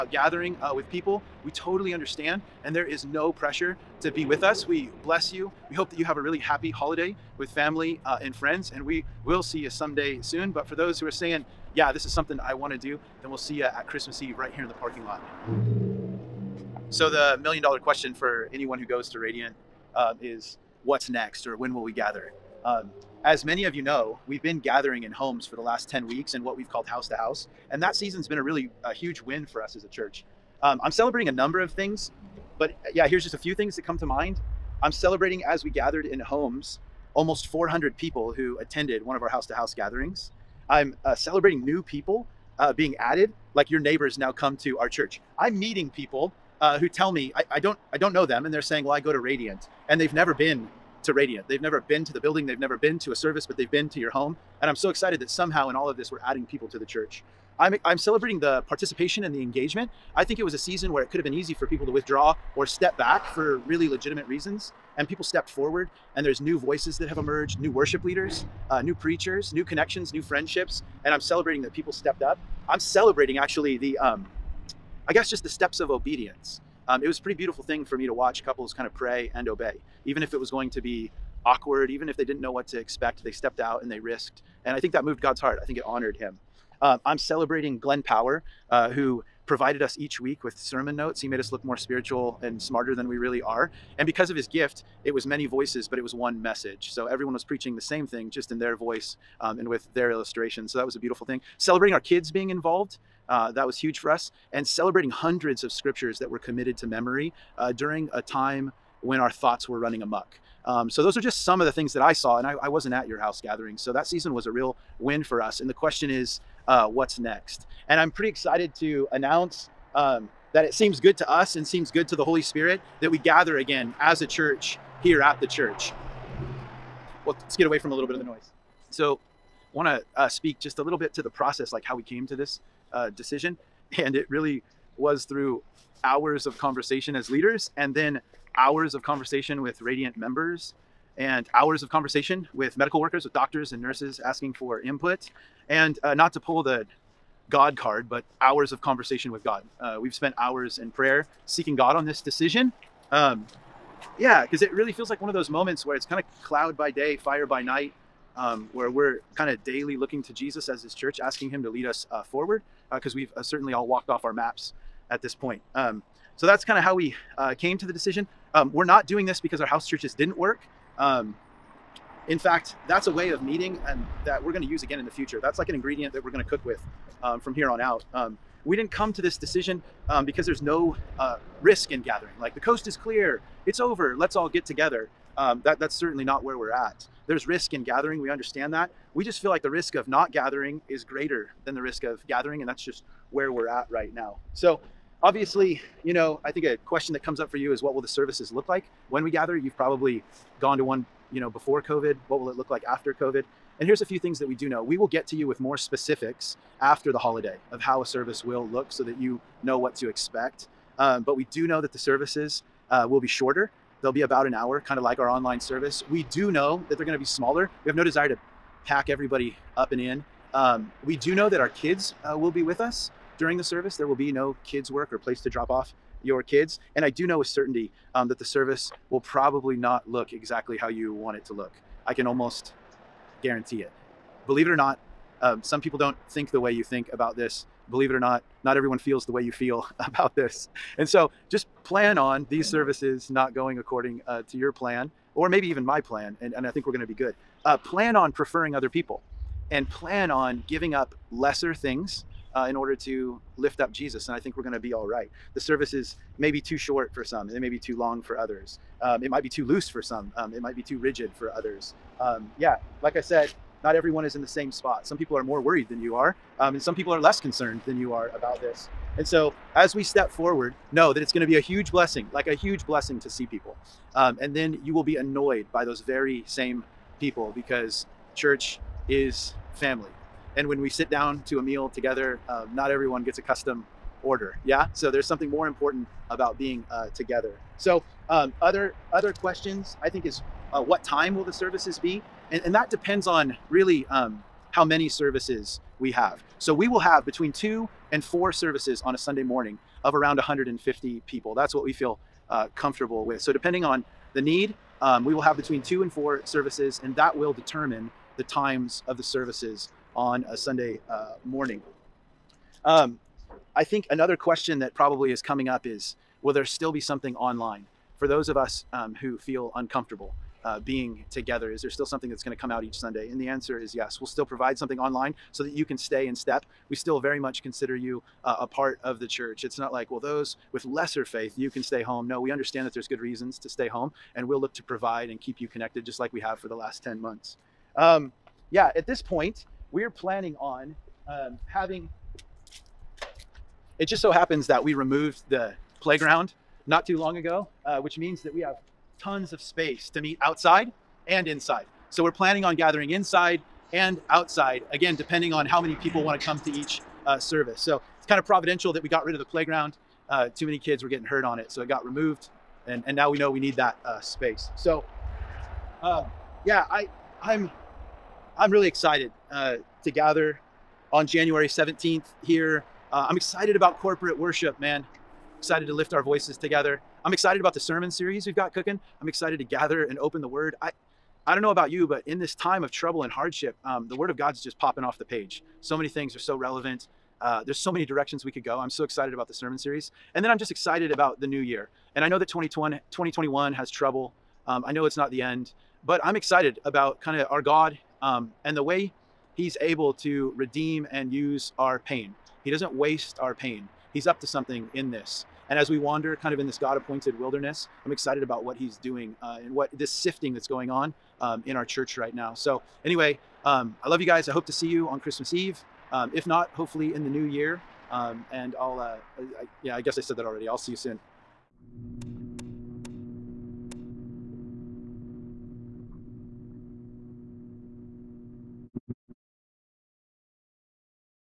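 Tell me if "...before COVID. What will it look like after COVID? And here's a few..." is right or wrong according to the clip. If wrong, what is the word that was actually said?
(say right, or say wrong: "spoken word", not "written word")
right.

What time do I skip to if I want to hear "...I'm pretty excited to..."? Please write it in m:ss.
1:57.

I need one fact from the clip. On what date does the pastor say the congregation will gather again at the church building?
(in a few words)
January 17th.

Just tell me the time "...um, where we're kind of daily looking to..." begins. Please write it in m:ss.
2:38.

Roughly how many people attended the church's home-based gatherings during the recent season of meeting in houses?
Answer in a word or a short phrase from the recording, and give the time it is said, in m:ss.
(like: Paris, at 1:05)
almost 400, at 0:37.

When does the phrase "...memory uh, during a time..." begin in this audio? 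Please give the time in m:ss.
1:46.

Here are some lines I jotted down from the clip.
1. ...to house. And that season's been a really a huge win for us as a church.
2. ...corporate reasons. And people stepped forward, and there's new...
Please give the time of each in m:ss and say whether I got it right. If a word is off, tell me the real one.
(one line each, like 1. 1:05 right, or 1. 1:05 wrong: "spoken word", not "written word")
1. 0:27 right
2. 1:03 wrong: "legitimate", not "corporate".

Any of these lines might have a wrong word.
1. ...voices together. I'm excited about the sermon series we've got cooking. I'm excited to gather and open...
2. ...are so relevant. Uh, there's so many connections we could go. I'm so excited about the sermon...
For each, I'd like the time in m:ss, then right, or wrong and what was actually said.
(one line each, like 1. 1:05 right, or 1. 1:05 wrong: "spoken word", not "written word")
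1. 6:16 right
2. 6:26 wrong: "directions", not "connections".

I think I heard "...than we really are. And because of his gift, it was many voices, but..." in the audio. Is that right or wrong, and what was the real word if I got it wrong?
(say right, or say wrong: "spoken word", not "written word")
right.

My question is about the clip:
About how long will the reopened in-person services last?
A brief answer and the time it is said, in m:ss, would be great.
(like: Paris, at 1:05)
about an hour, at 3:34.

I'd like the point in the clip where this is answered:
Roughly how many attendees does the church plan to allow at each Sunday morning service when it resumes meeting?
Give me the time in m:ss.
5:00.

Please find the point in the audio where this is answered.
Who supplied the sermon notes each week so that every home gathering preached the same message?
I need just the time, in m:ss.
1:27.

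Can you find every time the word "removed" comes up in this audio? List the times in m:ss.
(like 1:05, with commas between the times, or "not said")
5:44, 6:02.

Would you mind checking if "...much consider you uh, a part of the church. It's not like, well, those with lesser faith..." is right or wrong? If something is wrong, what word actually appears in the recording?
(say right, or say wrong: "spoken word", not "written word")
right.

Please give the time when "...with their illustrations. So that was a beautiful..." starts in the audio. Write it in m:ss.
1:39.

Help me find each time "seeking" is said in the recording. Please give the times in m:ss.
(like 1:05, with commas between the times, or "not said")
2:31.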